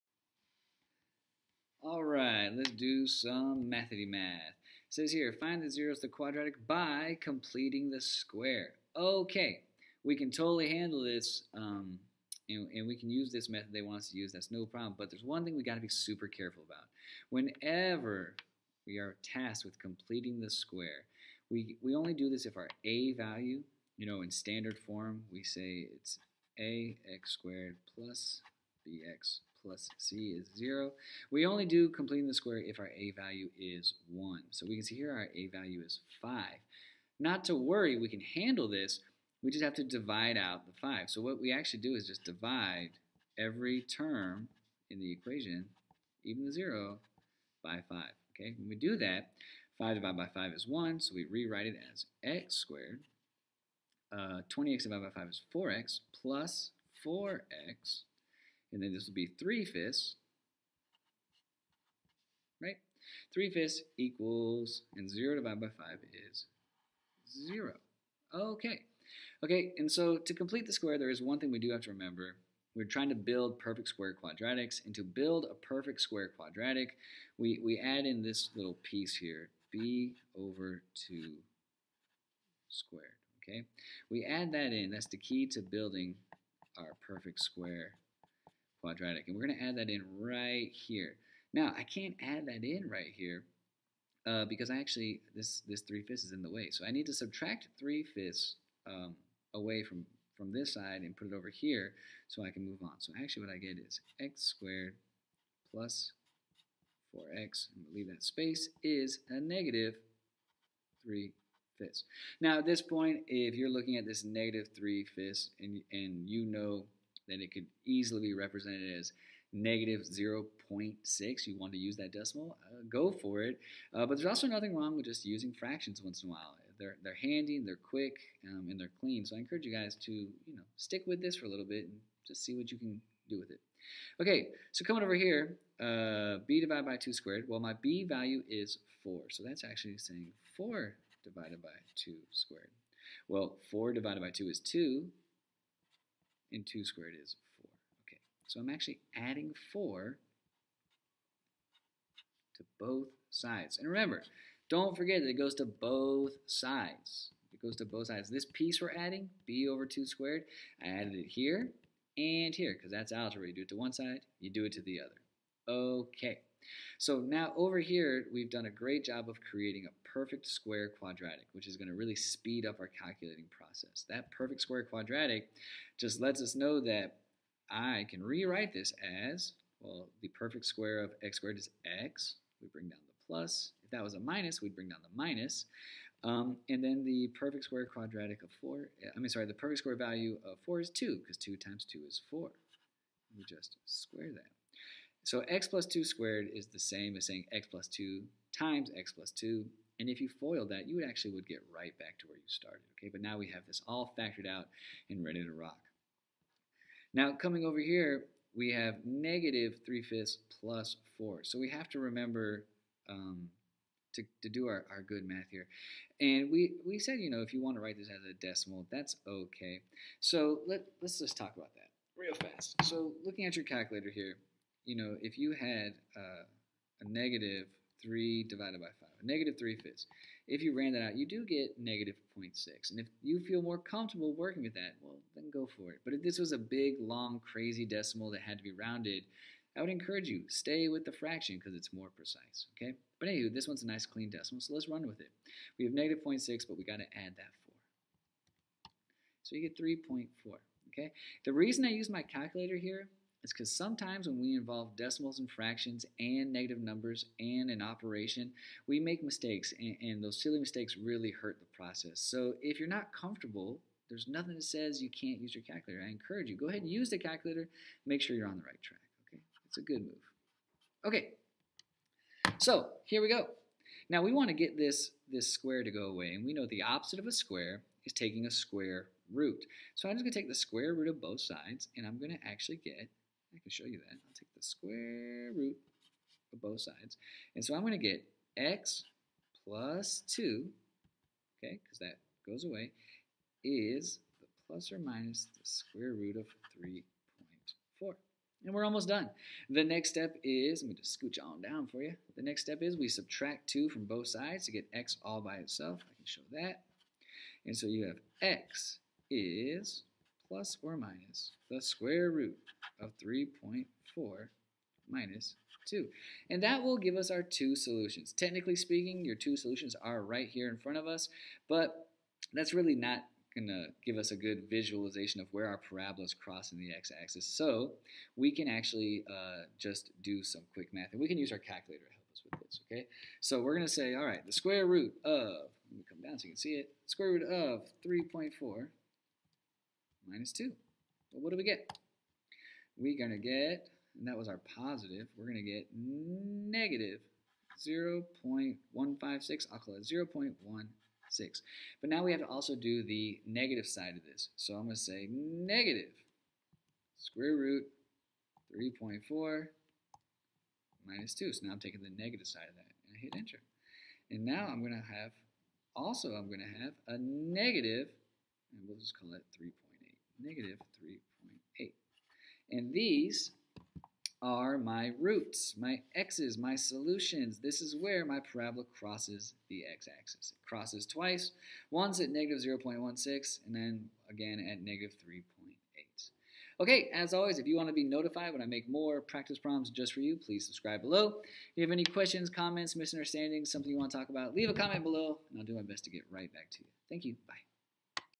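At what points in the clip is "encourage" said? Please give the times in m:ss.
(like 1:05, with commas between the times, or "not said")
2:09, 3:59, 4:26.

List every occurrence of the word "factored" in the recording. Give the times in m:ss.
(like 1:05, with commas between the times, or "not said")
3:24.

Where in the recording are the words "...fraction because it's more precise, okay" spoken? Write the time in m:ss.
4:01.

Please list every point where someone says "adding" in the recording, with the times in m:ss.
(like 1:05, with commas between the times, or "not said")
2:29, 2:38.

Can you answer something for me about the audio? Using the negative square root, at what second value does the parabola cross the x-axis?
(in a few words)
-3.8.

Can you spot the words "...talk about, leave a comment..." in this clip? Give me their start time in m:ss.
6:34.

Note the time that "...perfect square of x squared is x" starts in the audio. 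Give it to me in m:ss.
3:00.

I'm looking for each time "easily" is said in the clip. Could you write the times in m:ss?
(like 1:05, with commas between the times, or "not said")
1:57.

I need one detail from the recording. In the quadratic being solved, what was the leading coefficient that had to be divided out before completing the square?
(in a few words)
5.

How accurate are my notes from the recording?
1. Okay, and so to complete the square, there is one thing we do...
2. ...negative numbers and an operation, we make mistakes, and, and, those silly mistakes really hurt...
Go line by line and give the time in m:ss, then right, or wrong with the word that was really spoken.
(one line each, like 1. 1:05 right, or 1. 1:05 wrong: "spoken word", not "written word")
1. 1:09 right
2. 4:16 right.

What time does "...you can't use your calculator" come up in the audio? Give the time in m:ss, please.
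4:25.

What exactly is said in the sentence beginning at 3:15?
So x plus 2 squared is the same as saying x plus 2 times x plus 2.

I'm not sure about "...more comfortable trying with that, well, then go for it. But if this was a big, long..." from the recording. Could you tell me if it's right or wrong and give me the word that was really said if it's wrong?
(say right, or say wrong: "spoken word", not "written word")
wrong: "working", not "trying".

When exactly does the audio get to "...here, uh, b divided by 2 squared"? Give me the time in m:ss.
2:15.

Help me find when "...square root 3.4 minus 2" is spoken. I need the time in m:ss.
5:57.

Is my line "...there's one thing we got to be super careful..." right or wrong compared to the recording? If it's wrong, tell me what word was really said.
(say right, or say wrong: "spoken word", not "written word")
right.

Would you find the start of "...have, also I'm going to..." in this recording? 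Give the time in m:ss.
6:05.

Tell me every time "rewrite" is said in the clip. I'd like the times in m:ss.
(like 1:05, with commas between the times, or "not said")
0:51, 2:58.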